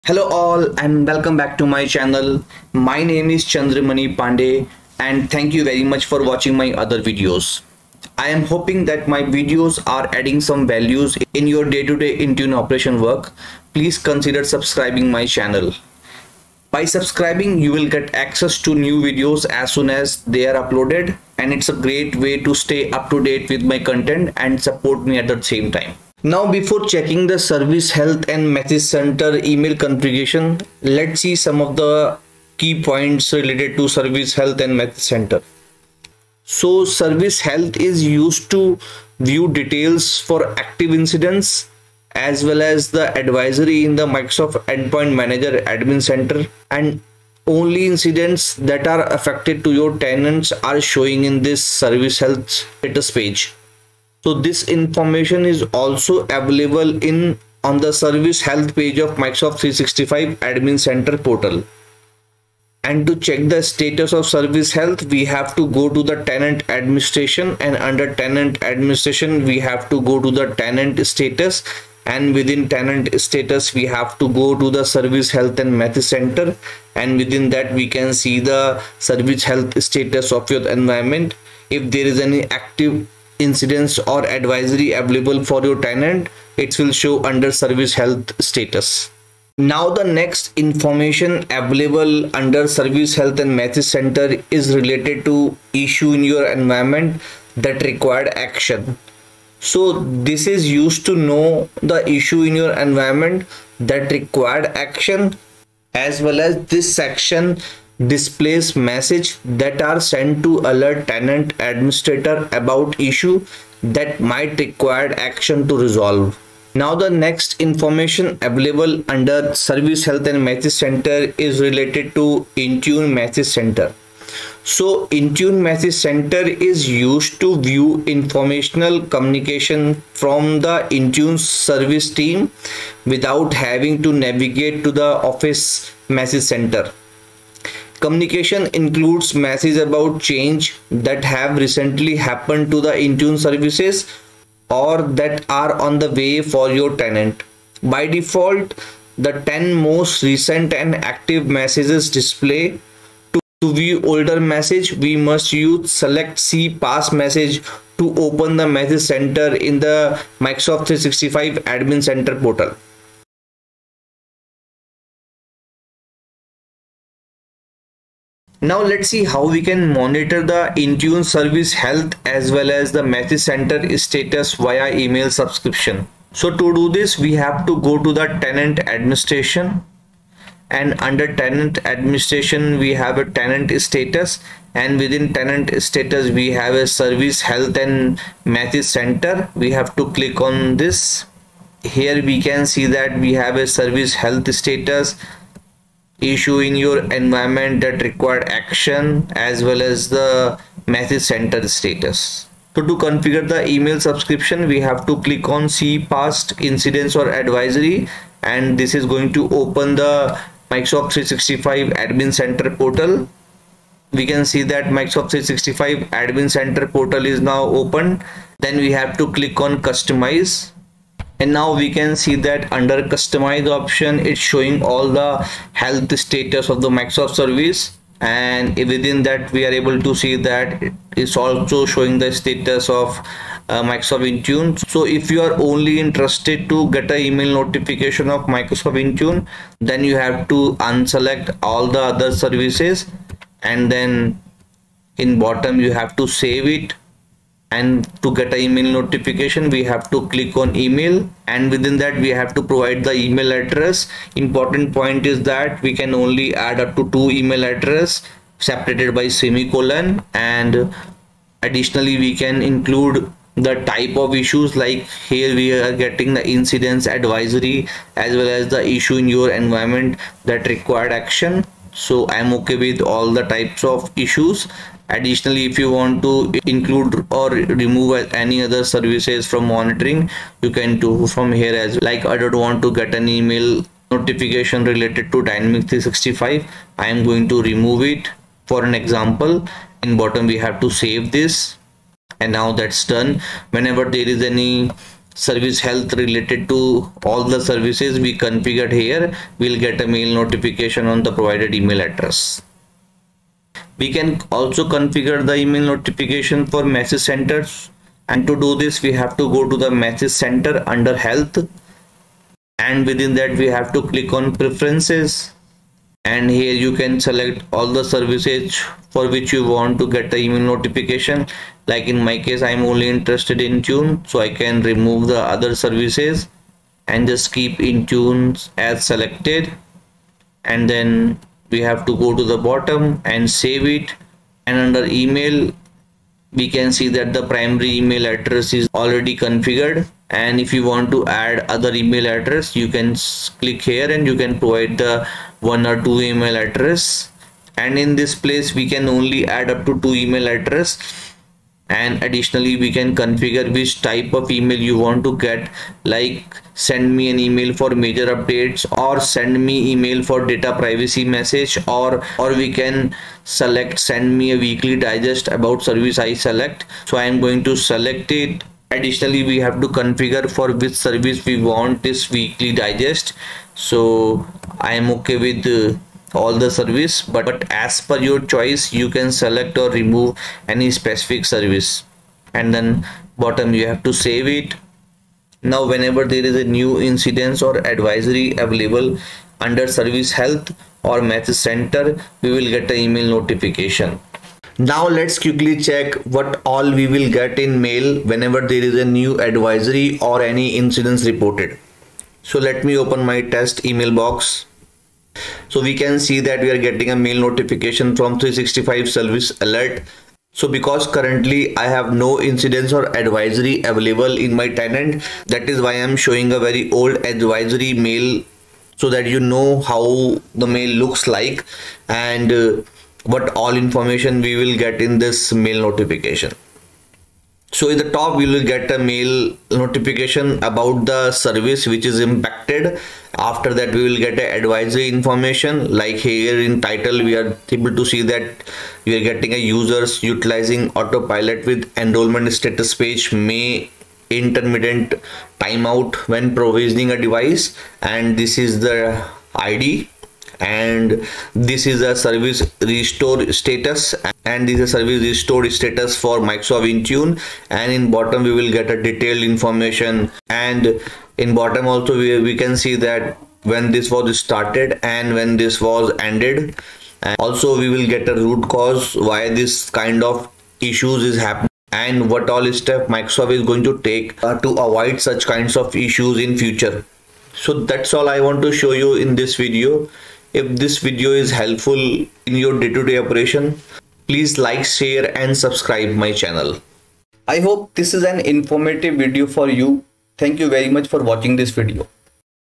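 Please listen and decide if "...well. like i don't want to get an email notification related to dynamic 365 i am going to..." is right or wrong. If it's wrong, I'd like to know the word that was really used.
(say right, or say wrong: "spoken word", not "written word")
right.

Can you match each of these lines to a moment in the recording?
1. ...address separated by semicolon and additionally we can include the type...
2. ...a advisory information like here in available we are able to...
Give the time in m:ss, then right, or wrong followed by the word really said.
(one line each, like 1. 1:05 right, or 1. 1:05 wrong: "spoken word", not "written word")
1. 4:17 right
2. 7:14 wrong: "title", not "available".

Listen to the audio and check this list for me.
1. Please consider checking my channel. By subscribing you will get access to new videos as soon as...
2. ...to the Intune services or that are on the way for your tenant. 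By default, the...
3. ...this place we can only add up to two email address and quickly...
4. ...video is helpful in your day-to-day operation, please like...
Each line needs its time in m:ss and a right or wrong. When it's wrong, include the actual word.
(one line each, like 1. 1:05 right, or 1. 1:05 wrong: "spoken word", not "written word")
1. 0:13 wrong: "subscribing", not "checking"
2. 2:22 right
3. 5:48 wrong: "additionally", not "quickly"
4. 8:00 right.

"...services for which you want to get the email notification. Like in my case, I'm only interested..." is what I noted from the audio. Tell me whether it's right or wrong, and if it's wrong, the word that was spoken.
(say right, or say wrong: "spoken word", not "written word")
right.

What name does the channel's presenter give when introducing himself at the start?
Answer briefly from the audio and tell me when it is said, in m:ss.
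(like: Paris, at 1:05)
Chander Mani Pandey, at 0:03.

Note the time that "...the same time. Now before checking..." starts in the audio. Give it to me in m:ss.
0:25.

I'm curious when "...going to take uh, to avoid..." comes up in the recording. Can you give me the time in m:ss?
7:53.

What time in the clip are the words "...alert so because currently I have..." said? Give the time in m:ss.
6:49.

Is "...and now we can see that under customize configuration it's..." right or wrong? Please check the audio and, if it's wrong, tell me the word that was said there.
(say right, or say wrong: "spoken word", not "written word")
wrong: "option", not "configuration".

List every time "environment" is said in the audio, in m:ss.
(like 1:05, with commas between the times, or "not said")
1:20, 1:36, 1:42, 3:17, 4:29.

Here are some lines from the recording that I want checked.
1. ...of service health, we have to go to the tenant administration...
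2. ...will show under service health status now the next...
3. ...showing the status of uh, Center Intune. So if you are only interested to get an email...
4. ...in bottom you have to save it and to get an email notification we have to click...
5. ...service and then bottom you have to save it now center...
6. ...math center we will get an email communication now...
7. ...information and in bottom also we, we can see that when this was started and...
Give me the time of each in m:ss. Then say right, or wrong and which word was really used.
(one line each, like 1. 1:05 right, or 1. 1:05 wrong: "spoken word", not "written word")
1. 1:04 right
2. 1:26 right
3. 3:51 wrong: "Microsoft", not "Center"
4. 4:05 right
5. 6:21 wrong: "whenever", not "center"
6. 6:31 wrong: "notification", not "communication"
7. 7:39 right.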